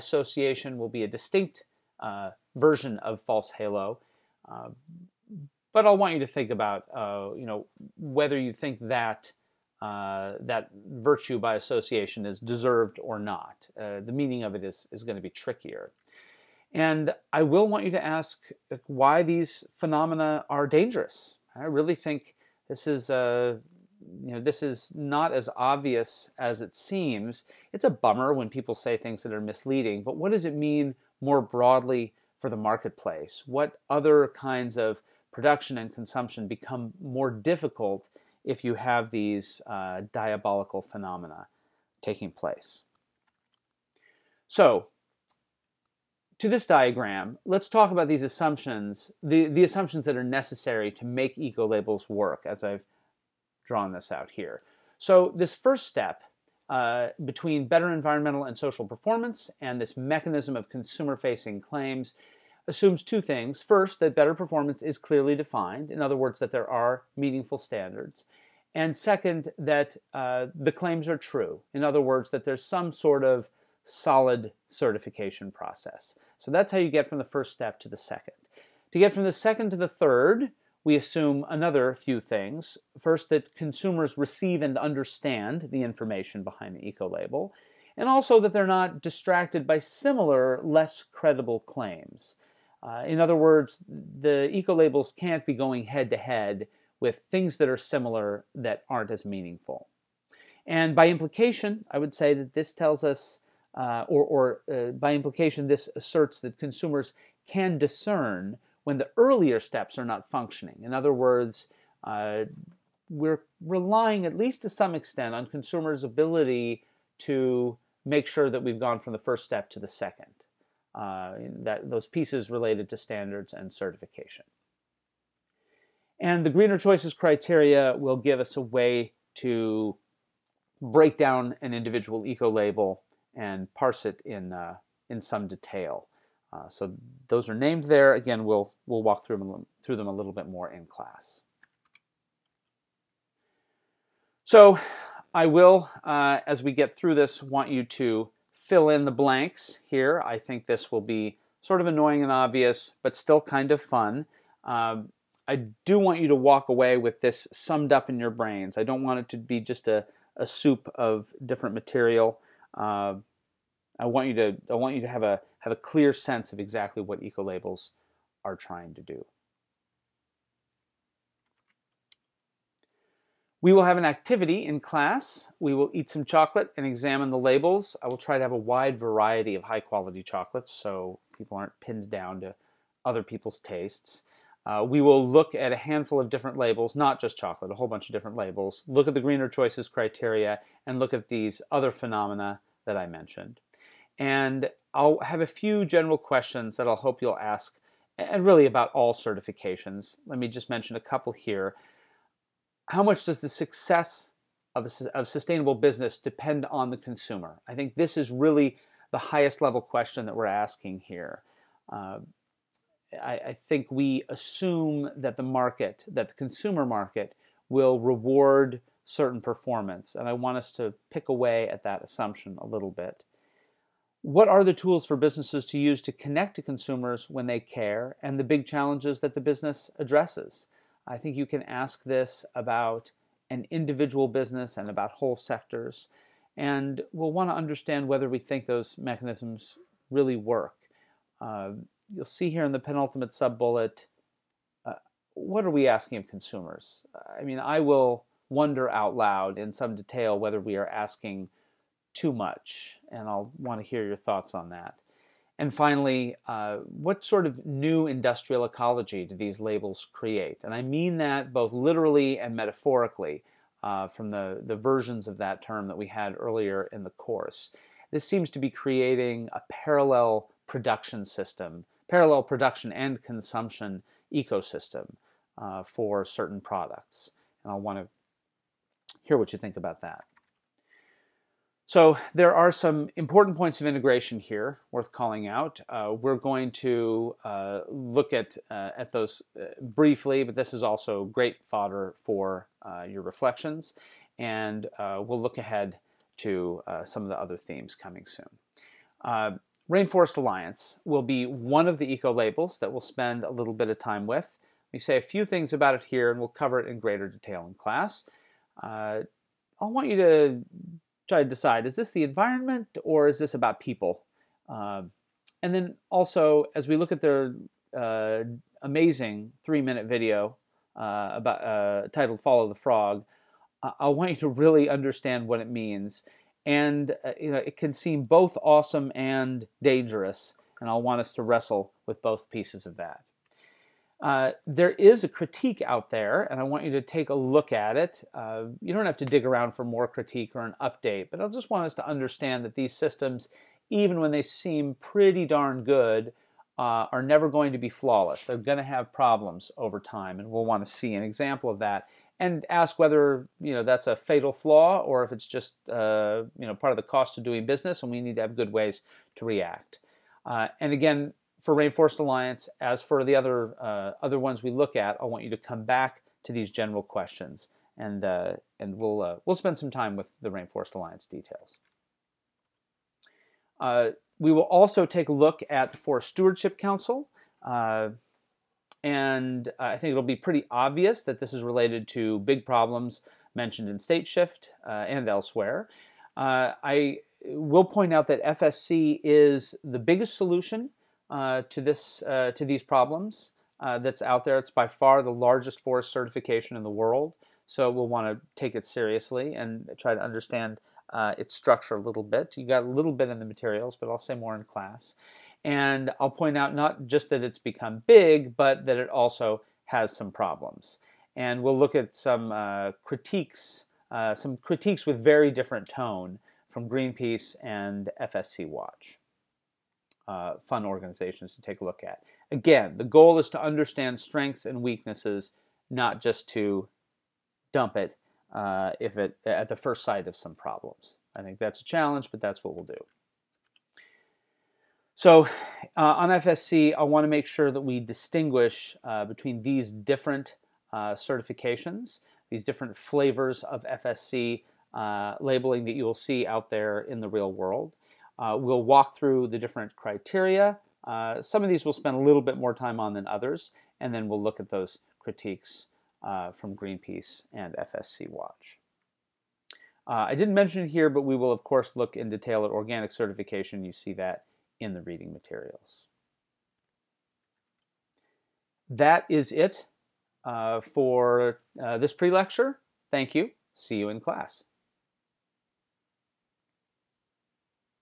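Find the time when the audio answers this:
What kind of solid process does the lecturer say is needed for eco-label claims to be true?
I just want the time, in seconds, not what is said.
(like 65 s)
74 s.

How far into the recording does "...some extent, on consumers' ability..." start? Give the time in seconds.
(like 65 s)
114 s.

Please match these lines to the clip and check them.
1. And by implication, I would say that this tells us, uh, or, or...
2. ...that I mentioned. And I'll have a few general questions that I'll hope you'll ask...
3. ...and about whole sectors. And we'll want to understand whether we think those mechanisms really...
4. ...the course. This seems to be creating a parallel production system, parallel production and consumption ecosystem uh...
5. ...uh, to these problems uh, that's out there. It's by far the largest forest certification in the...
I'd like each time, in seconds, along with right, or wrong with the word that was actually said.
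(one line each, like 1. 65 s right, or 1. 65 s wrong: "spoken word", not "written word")
1. 100 s right
2. 192 s right
3. 234 s right
4. 267 s right
5. 392 s right.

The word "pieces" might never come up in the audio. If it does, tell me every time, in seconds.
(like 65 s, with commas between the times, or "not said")
122 s, 332 s.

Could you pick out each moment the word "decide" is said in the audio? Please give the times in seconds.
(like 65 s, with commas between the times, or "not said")
311 s.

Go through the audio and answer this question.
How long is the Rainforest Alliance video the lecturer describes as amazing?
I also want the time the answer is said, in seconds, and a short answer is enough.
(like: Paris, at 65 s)
3 minutes, at 319 s.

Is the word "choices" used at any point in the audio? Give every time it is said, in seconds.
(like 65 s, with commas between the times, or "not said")
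126 s, 189 s.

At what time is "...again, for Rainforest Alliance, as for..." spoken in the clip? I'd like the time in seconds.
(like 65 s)
360 s.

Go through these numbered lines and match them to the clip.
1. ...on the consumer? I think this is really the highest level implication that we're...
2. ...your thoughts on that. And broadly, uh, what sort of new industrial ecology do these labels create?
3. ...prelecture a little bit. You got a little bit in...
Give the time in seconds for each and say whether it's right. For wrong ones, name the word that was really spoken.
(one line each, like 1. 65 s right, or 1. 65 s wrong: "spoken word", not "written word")
1. 206 s wrong: "question", not "implication"
2. 254 s wrong: "finally", not "broadly"
3. 401 s wrong: "structure", not "prelecture".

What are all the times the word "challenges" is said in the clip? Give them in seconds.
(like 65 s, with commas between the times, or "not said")
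228 s, 431 s.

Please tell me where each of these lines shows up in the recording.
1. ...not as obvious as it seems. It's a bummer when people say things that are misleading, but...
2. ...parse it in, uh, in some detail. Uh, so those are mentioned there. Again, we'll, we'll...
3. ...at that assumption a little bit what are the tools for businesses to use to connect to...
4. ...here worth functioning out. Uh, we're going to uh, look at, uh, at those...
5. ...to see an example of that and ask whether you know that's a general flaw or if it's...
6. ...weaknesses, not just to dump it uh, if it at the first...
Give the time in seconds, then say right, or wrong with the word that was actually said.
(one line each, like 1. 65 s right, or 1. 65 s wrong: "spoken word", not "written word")
1. 24 s right
2. 133 s wrong: "named", not "mentioned"
3. 221 s right
4. 284 s wrong: "calling", not "functioning"
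5. 350 s wrong: "fatal", not "general"
6. 424 s right.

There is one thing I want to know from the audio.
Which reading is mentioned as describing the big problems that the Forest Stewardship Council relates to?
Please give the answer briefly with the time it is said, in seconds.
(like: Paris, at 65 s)
State Shift, at 383 s.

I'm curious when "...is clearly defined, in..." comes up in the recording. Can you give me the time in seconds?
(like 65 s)
64 s.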